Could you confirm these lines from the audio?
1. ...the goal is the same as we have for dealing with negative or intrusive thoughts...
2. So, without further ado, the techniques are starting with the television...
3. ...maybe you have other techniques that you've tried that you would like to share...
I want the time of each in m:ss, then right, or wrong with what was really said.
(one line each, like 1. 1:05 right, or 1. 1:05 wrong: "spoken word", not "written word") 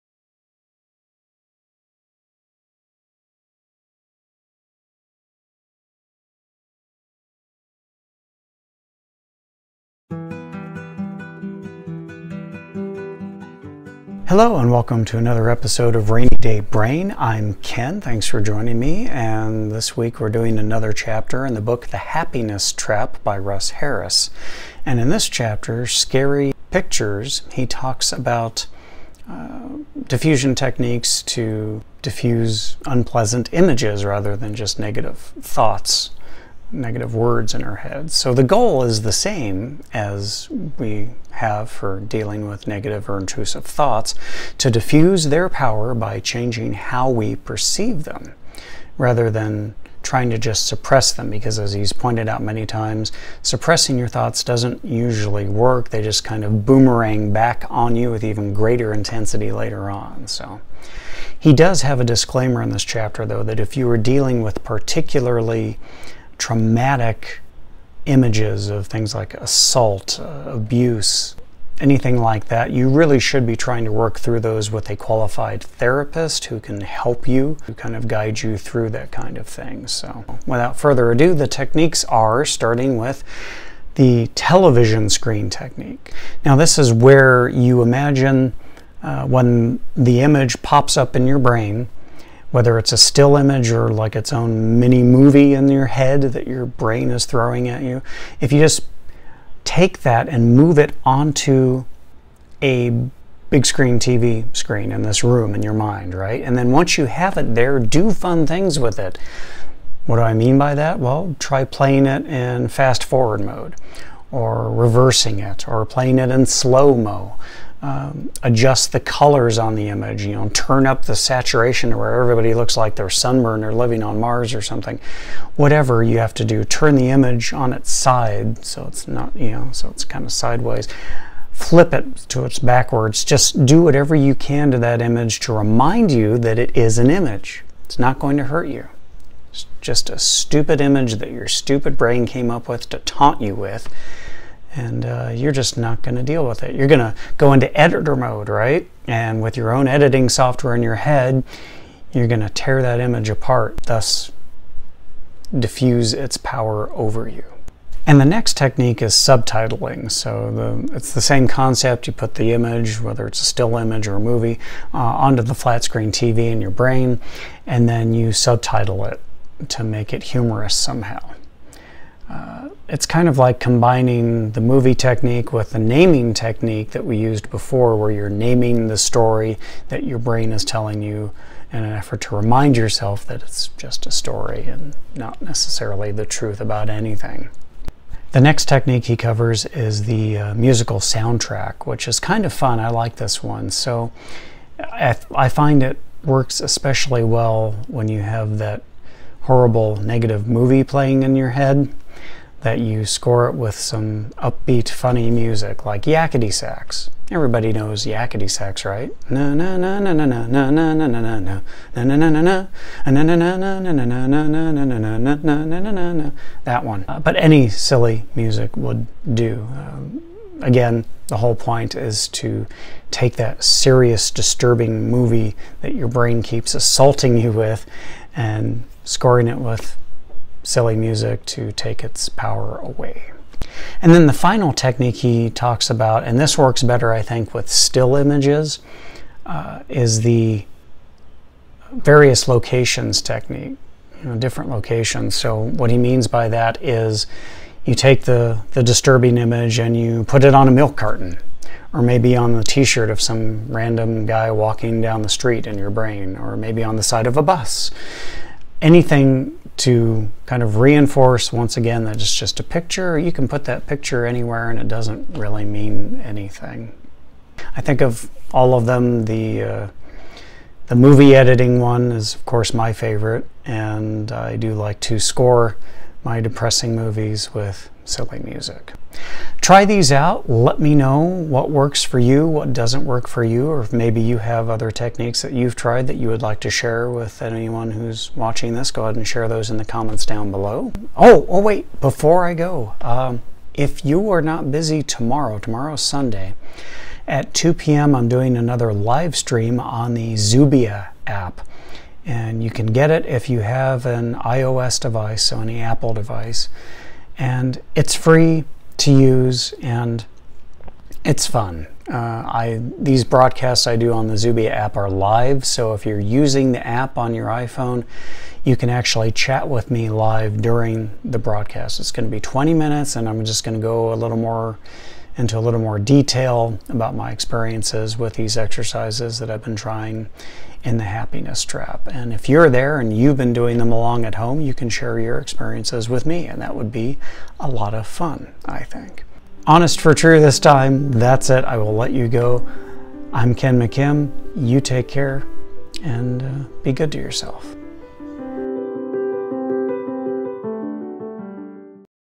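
1. 0:38 right
2. 1:19 right
3. 4:43 right.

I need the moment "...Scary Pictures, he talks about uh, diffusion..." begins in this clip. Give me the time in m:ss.
0:25.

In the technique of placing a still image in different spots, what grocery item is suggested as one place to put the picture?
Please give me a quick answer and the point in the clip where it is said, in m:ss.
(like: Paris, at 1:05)
Milk carton, at 4:10.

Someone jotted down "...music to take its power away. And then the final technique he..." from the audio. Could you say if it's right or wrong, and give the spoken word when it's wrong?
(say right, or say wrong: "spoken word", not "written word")
right.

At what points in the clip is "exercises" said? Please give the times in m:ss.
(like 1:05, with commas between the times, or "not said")
5:28.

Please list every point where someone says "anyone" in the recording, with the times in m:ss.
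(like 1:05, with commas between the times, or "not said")
4:47.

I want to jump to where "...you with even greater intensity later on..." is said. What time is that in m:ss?
0:57.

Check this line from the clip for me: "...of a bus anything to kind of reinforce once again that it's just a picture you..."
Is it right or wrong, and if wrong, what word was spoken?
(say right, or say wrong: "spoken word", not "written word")
right.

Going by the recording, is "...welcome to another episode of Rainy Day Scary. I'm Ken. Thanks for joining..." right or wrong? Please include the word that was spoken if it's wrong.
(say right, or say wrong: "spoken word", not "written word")
wrong: "Brain", not "Scary".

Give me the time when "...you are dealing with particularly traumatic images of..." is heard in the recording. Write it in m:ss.
1:03.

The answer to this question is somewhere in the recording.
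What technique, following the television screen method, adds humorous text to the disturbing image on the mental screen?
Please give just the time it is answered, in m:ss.
2:39.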